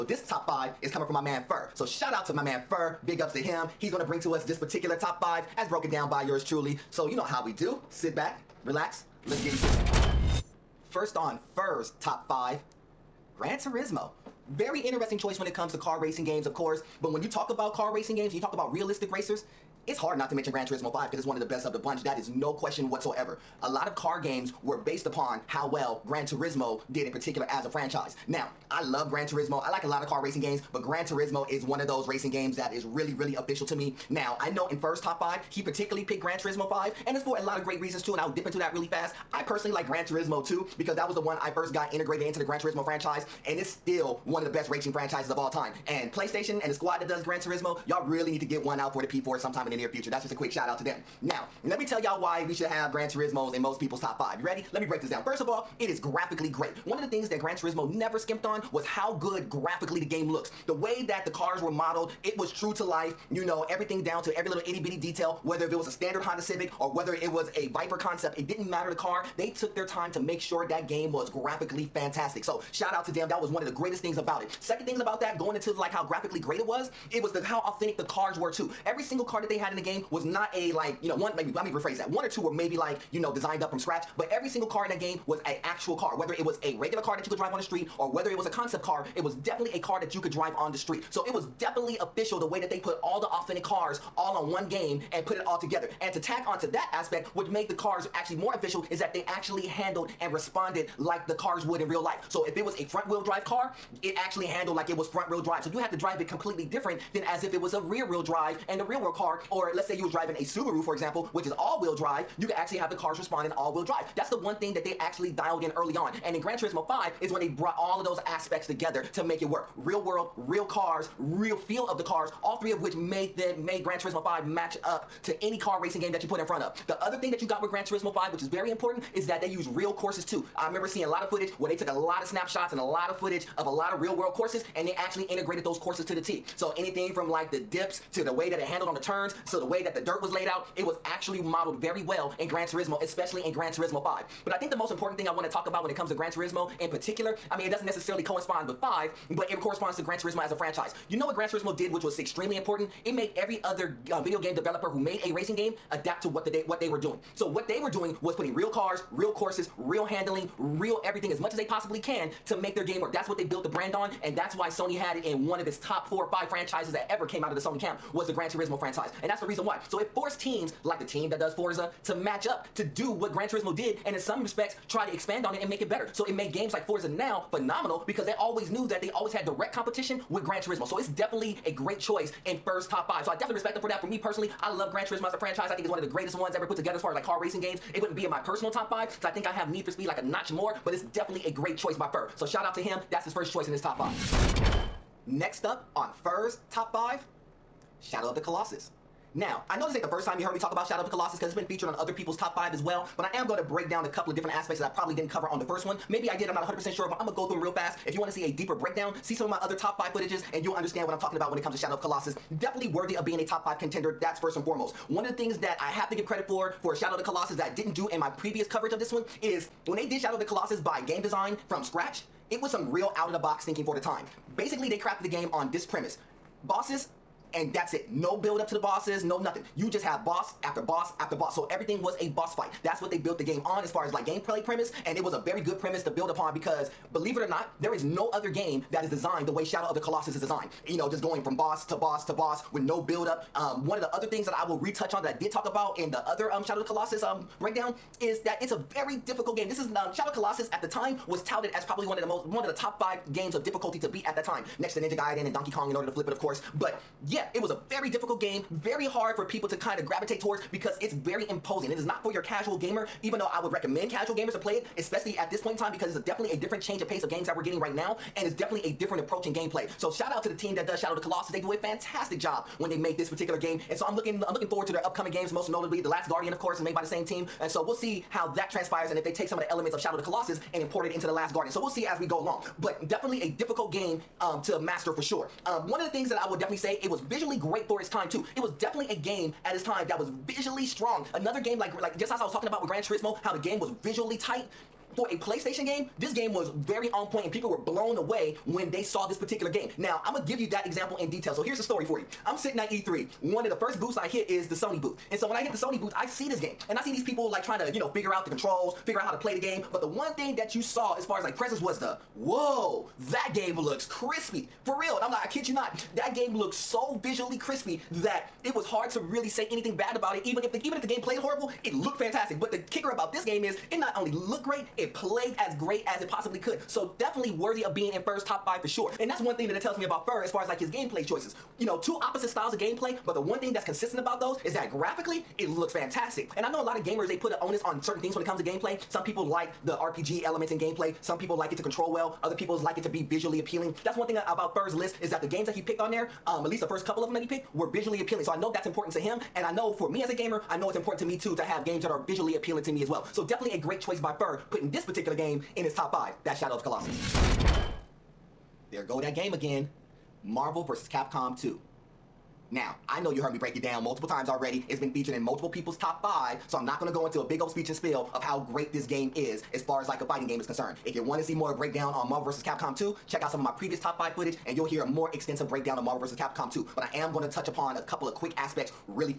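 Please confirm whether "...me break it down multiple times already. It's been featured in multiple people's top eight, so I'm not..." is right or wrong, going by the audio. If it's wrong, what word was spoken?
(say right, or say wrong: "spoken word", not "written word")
wrong: "five", not "eight".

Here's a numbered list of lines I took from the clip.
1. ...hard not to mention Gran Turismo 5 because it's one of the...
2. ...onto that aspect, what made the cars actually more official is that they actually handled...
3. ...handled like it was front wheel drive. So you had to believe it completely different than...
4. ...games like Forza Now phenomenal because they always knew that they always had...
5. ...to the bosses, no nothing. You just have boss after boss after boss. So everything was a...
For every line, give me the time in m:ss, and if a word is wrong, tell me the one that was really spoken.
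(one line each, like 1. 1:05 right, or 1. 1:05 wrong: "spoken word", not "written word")
1. 0:19 right
2. 1:36 right
3. 1:44 wrong: "drive", not "believe"
4. 2:56 right
5. 3:48 right.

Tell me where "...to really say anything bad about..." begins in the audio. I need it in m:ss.
5:19.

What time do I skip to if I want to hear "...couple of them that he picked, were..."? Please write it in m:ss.
5:47.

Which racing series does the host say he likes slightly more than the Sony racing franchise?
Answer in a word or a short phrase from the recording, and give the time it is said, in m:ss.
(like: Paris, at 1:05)
Need for Speed, at 3:09.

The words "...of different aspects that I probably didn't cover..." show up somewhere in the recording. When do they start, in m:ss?
3:24.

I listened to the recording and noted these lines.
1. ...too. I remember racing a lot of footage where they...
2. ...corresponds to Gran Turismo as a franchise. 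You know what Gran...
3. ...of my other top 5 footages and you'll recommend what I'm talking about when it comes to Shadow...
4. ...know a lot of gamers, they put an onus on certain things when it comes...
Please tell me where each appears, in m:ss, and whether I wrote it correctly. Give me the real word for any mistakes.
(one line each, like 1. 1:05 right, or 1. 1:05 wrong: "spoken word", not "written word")
1. 2:10 wrong: "seeing", not "racing"
2. 2:29 right
3. 3:29 wrong: "understand", not "recommend"
4. 5:36 right.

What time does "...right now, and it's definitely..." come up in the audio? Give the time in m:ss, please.
4:27.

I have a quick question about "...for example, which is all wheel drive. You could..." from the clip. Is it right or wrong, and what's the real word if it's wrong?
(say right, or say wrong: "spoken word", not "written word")
right.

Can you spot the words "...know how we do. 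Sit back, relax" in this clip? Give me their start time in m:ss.
0:07.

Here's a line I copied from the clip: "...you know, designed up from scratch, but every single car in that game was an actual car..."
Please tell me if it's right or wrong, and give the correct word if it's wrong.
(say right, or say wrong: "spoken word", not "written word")
right.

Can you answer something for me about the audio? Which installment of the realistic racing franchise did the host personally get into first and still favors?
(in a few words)
Gran Turismo 2.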